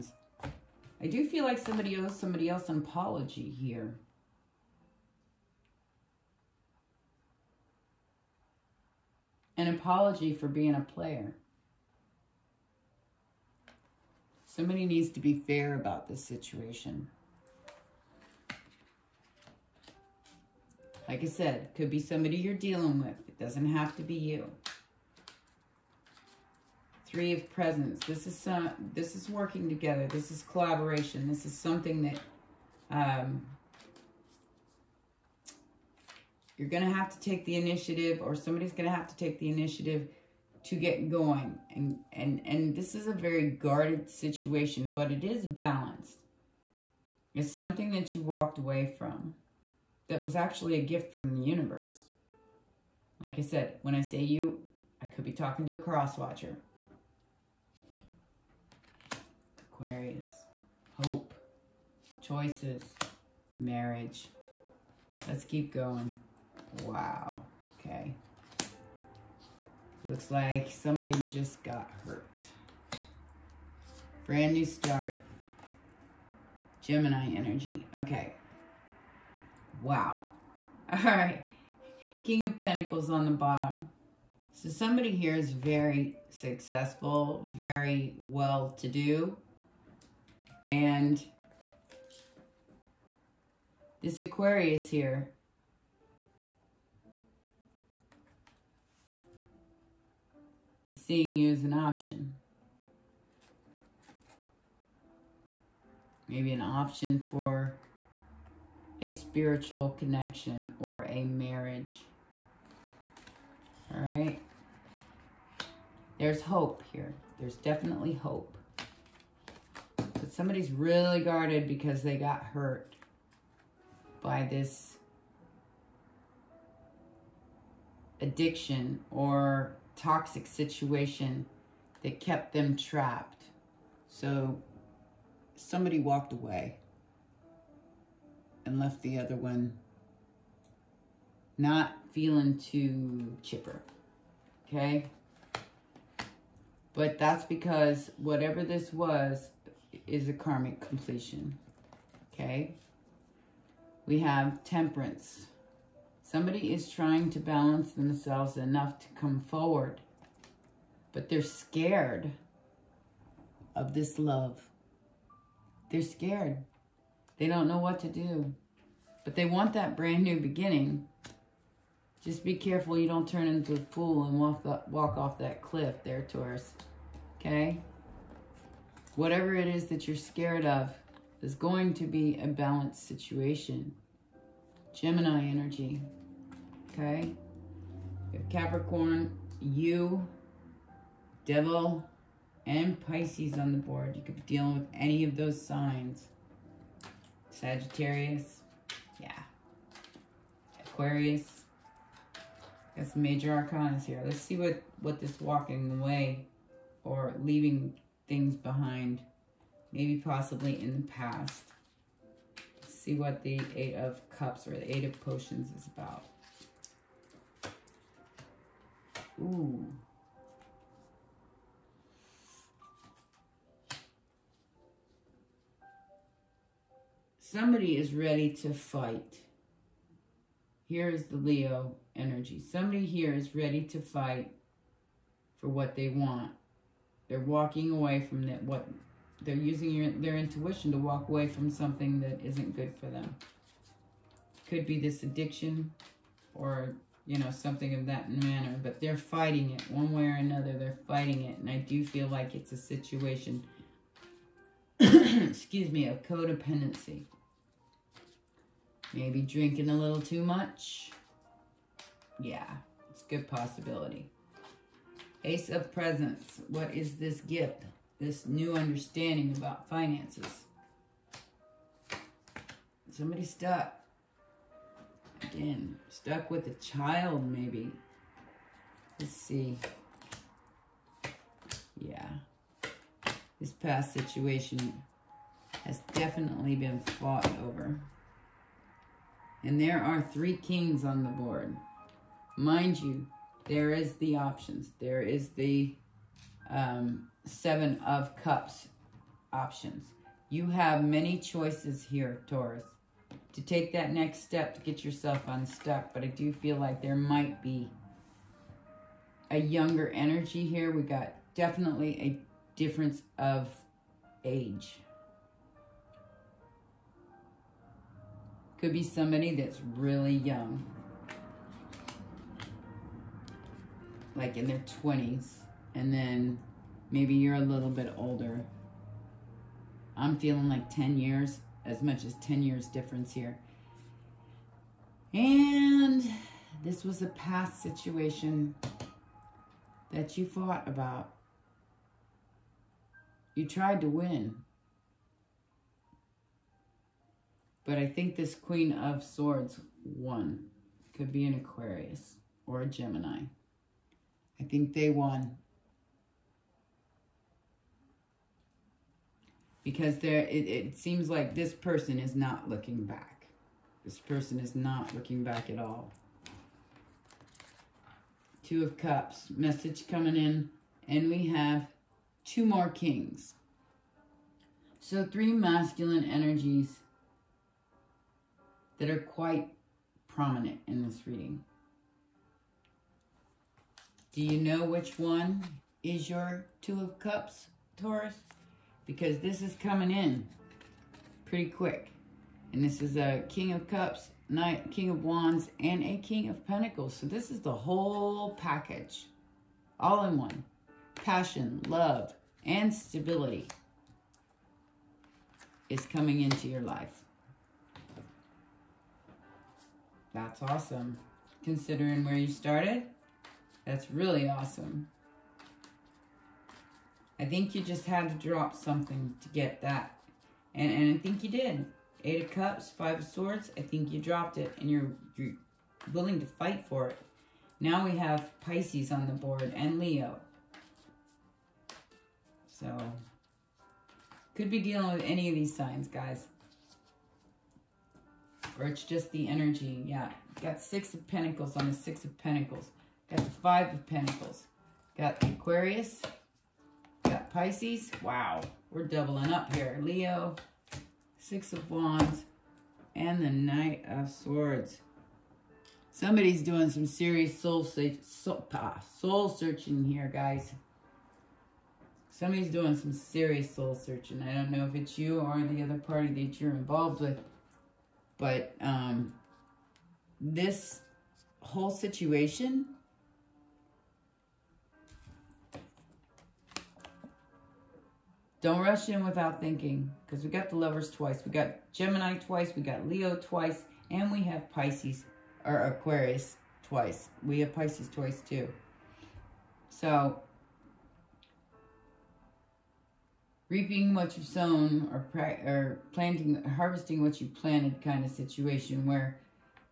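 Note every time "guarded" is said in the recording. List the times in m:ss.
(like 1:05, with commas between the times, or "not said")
0:43, 2:01.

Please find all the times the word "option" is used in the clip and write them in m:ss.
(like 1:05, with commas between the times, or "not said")
1:41, 1:46, 4:54, 4:59.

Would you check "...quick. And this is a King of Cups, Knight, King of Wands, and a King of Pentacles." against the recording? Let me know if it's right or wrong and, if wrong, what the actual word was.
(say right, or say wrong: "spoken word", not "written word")
right.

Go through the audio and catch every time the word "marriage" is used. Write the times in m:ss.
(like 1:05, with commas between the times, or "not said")
1:03, 1:51.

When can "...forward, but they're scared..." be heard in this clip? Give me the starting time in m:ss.
2:39.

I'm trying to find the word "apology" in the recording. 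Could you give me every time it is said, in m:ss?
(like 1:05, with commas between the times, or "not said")
0:02, 0:09.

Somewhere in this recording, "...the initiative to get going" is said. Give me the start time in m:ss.
0:39.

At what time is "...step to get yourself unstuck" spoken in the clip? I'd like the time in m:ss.
5:04.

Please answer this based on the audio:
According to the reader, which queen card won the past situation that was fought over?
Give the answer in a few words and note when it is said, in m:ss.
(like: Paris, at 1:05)
Queen of Swords, at 5:48.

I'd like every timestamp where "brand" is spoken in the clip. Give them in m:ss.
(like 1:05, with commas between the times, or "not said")
1:14, 2:49.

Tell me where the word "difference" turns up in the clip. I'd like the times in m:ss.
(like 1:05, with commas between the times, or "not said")
5:12, 5:32.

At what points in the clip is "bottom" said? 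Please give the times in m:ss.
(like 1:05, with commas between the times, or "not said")
1:23.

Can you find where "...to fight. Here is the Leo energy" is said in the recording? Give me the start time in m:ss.
3:48.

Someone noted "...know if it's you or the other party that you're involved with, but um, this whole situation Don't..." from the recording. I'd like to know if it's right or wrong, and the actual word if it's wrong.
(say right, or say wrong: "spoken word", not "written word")
right.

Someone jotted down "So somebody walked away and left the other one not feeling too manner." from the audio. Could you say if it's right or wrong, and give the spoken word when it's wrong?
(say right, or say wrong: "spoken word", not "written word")
wrong: "chipper", not "manner".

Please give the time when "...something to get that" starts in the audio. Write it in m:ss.
6:58.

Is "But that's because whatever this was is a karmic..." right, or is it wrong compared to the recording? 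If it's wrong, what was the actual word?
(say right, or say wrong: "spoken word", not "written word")
right.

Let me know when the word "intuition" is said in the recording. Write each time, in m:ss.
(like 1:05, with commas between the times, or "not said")
4:00.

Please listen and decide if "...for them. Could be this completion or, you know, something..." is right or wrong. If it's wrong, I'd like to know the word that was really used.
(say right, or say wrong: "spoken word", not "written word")
wrong: "addiction", not "completion".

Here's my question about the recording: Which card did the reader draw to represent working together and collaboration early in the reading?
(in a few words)
Three of Presents.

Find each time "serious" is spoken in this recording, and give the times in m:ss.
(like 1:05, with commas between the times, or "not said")
7:37, 7:43.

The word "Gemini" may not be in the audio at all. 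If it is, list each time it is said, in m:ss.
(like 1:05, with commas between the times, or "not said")
1:16, 3:04, 5:52, 8:01.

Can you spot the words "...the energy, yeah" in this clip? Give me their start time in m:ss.
7:19.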